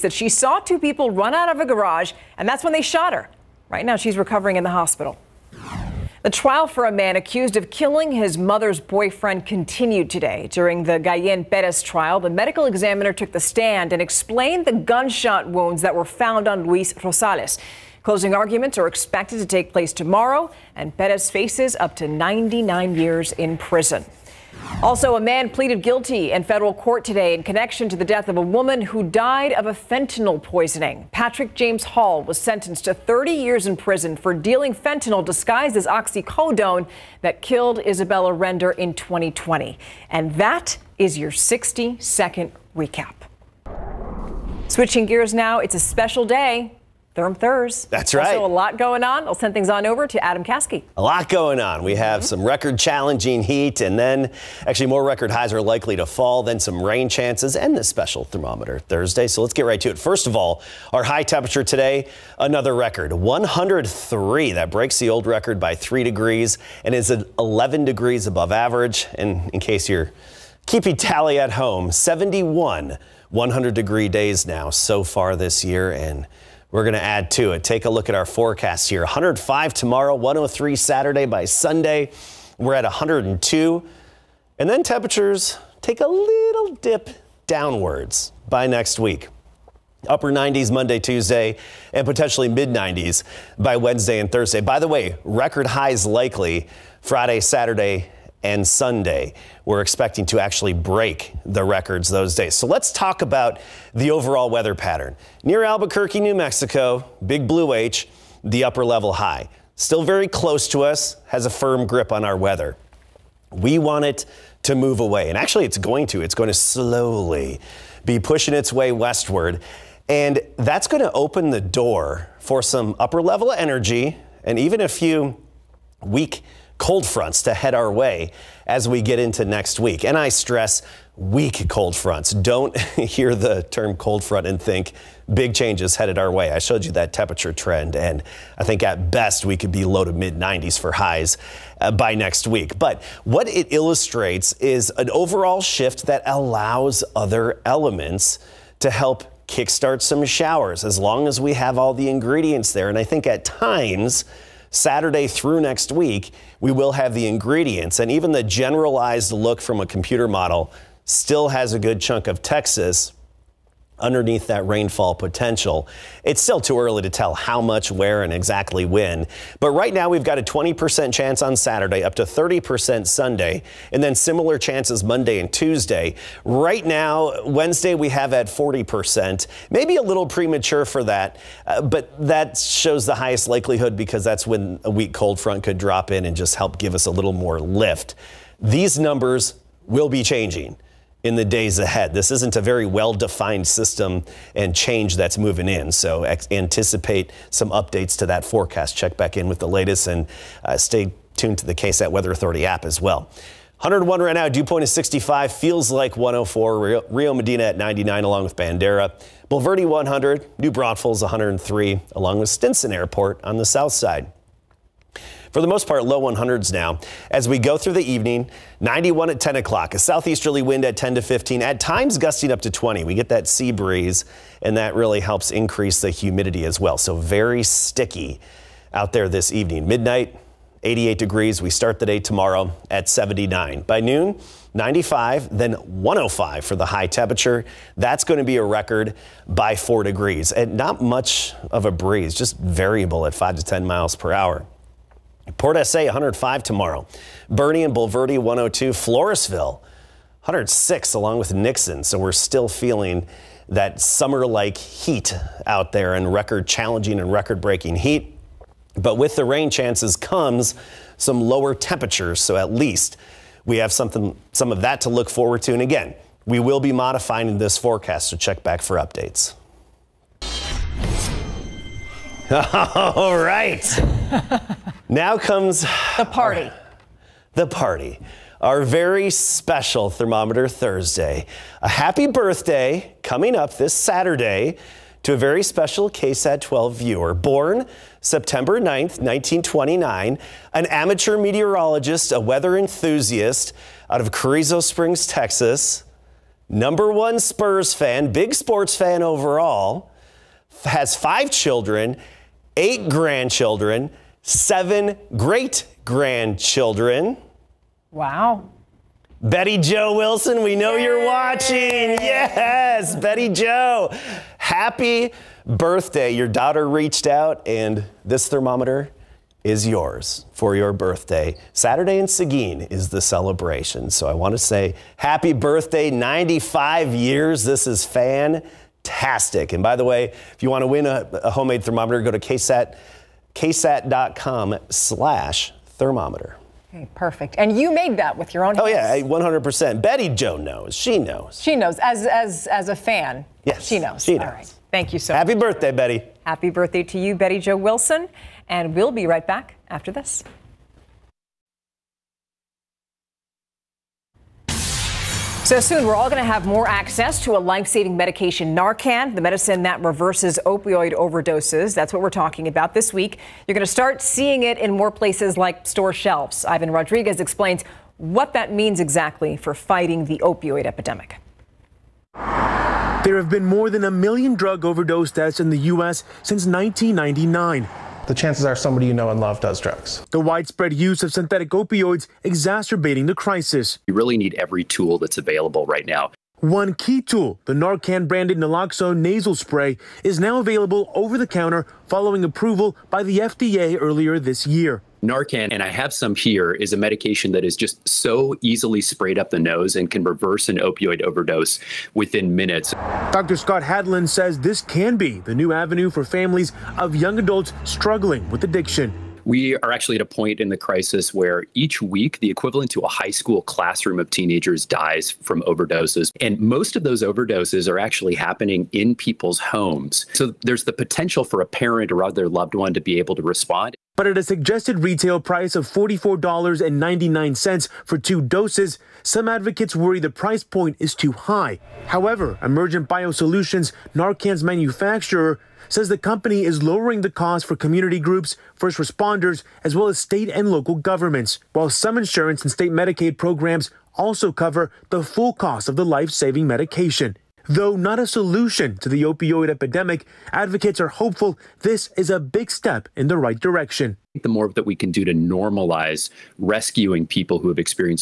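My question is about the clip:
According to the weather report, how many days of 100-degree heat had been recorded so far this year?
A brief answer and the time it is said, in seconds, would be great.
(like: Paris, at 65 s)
71, at 71 s.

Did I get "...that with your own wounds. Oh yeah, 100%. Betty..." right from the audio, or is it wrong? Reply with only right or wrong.
wrong.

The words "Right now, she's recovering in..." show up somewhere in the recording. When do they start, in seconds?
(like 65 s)
3 s.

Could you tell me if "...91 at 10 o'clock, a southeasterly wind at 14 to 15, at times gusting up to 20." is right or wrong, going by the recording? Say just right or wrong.
wrong.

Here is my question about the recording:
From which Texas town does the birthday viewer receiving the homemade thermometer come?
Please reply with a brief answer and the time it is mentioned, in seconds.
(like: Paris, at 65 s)
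Carrizo Springs, at 294 s.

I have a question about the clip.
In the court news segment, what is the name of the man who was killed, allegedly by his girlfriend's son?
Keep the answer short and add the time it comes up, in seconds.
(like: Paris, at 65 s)
Luis Rosales, at 16 s.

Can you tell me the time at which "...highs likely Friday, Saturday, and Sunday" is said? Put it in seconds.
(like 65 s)
95 s.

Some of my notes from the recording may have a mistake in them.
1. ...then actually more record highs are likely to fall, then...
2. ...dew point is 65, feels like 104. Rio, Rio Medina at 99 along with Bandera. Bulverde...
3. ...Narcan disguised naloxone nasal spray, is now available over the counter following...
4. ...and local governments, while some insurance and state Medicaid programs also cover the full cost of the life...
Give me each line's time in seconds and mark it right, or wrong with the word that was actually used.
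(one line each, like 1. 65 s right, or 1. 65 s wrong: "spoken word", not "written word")
1. 53 s right
2. 204 s right
3. 387 s wrong: "branded", not "disguised"
4. 440 s right.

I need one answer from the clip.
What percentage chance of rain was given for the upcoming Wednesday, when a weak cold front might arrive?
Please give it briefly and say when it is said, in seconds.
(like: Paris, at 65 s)
40%, at 178 s.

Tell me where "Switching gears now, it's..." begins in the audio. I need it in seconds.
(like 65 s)
44 s.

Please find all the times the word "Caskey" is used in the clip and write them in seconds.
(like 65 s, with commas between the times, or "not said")
50 s.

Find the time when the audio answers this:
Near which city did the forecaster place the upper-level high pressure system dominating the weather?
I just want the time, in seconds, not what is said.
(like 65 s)
105 s.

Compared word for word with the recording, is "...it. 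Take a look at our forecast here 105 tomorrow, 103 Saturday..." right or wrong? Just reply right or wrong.
right.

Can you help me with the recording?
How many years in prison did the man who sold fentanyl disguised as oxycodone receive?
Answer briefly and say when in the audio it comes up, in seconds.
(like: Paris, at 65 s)
30, at 32 s.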